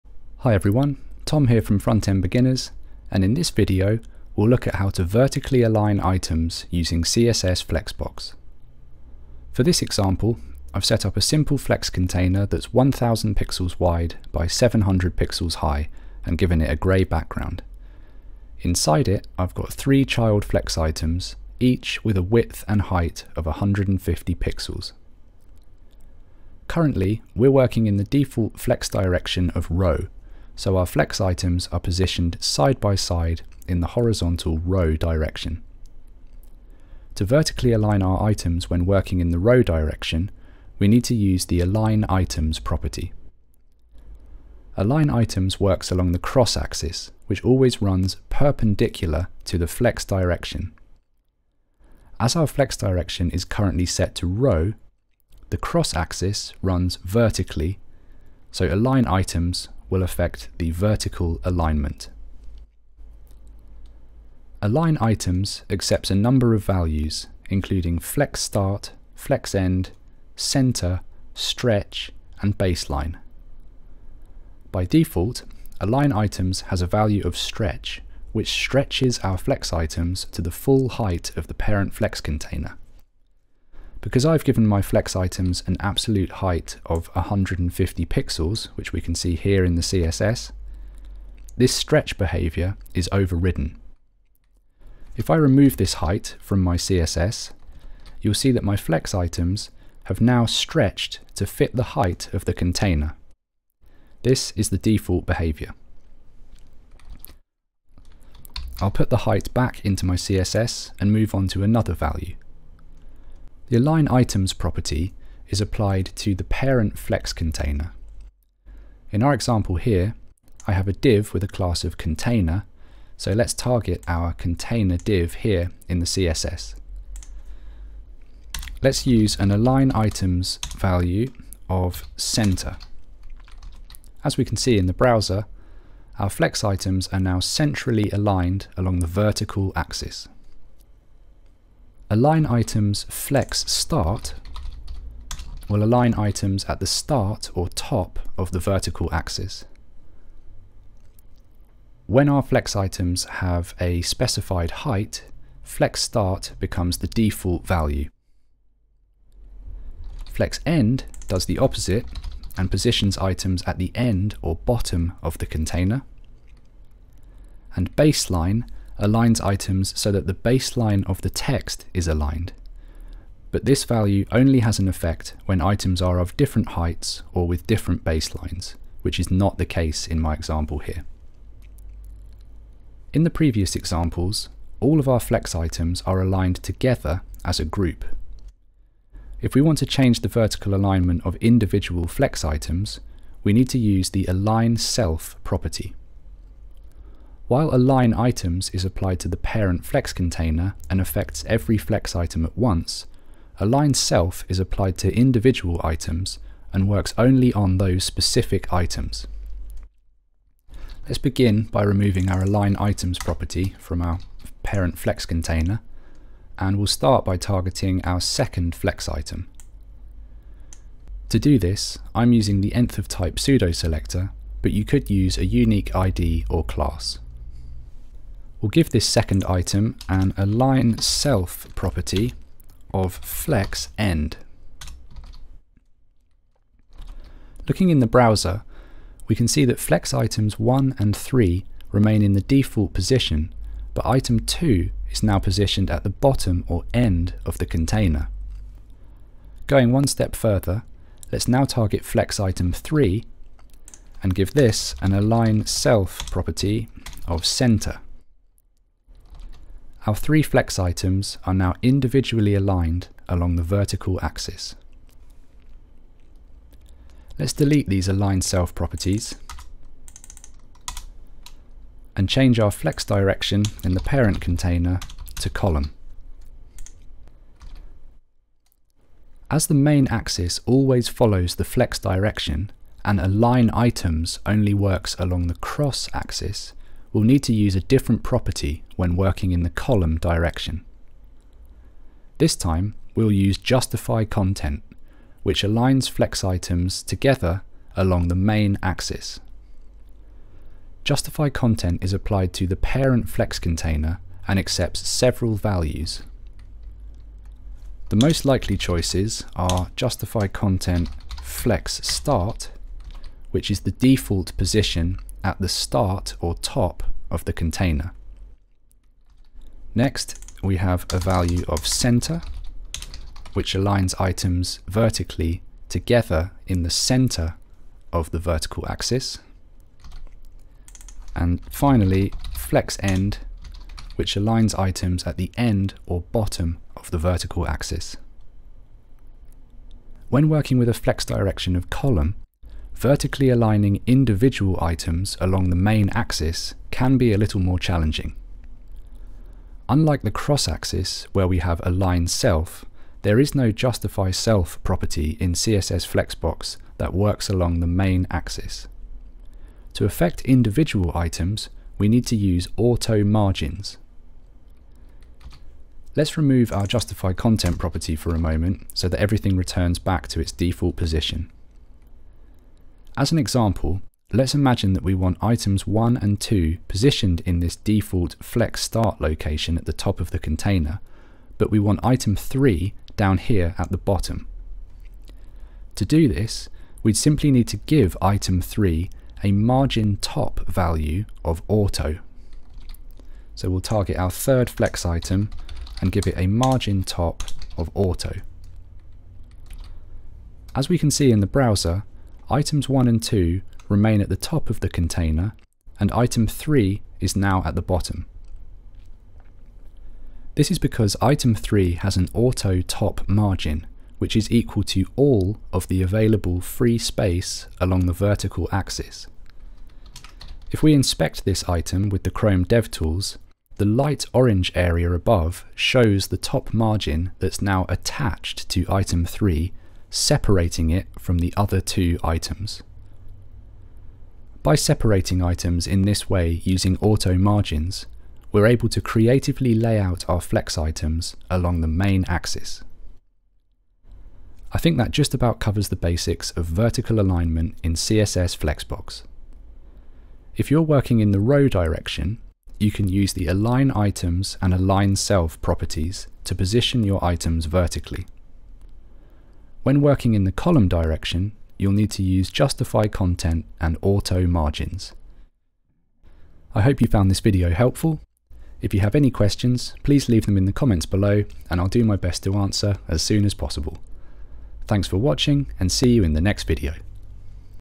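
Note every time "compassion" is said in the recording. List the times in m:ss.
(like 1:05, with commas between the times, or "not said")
not said.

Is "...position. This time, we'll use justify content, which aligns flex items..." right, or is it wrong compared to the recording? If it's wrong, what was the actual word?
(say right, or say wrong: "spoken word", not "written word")
wrong: "direction", not "position".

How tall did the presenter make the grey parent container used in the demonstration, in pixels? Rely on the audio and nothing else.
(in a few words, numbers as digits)
700.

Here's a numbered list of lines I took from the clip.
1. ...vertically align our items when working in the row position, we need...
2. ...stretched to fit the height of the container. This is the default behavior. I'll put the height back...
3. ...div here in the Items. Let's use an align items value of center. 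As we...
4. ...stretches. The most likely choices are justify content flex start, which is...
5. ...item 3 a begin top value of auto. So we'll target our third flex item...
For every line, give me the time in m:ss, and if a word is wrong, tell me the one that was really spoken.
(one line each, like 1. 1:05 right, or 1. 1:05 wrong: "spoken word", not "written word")
1. 0:37 wrong: "direction", not "position"
2. 1:40 right
3. 2:04 wrong: "CSS", not "Items"
4. 5:05 wrong: "values", not "stretches"
5. 6:28 wrong: "margin", not "begin".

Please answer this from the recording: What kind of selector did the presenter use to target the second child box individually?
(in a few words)
nth of type.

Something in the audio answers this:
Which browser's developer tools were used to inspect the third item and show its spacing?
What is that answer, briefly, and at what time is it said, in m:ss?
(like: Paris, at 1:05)
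Chrome, at 7:02.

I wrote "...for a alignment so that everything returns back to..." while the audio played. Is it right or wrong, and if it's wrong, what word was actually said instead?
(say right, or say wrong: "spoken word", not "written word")
wrong: "moment", not "alignment".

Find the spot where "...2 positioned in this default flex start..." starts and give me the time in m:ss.
6:16.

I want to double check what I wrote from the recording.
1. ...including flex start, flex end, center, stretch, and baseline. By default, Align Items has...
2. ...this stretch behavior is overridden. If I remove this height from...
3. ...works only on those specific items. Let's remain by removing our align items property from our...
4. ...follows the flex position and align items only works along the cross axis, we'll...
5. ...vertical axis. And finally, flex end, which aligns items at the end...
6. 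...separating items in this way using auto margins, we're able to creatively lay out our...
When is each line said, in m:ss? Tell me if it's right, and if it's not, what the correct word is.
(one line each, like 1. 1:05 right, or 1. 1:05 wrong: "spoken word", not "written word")
1. 1:07 right
2. 1:31 right
3. 3:26 wrong: "begin", not "remain"
4. 4:41 wrong: "direction", not "position"
5. 5:28 right
6. 7:14 right.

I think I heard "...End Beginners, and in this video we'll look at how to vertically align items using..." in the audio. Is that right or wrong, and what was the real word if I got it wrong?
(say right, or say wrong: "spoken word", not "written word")
right.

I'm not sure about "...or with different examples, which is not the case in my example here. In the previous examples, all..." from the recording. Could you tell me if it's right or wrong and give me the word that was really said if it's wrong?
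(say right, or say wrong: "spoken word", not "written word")
wrong: "baselines", not "examples".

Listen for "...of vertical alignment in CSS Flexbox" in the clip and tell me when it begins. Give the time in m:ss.
7:26.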